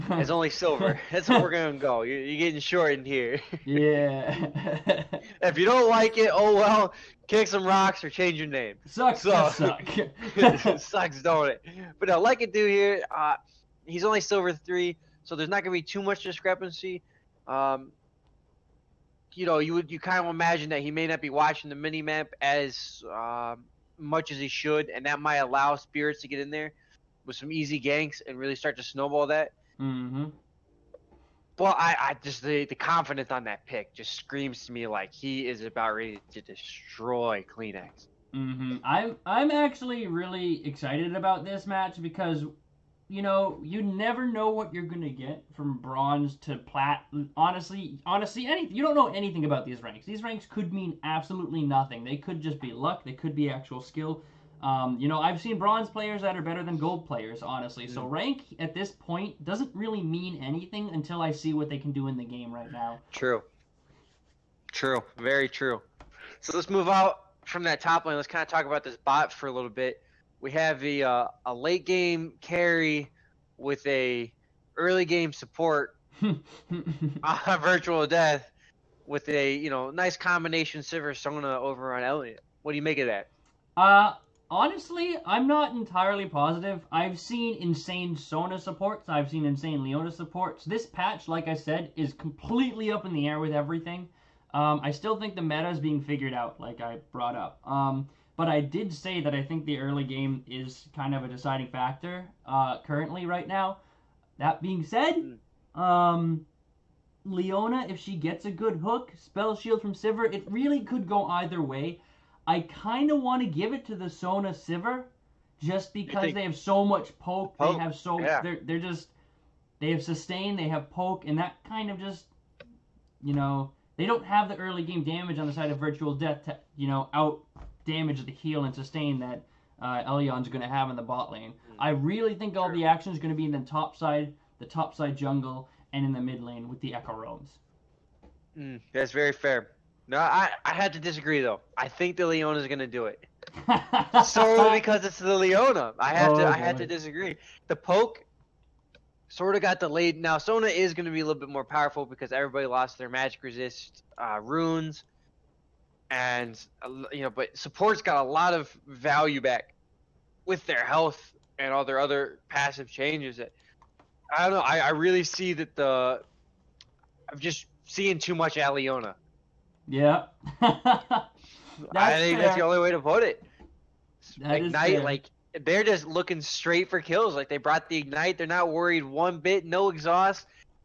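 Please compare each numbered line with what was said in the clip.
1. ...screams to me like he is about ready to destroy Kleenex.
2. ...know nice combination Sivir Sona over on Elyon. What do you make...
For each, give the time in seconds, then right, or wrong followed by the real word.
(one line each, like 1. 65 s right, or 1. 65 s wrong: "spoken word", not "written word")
1. 34 s right
2. 79 s right.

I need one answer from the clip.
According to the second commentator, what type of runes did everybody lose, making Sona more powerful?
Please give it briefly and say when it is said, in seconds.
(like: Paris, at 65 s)
Magic resist, at 153 s.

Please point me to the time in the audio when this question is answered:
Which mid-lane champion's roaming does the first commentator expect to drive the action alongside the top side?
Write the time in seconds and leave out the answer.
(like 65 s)
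136 s.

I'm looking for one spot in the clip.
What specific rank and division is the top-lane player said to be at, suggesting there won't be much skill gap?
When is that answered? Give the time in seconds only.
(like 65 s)
14 s.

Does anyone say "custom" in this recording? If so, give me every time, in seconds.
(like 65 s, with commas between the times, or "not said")
not said.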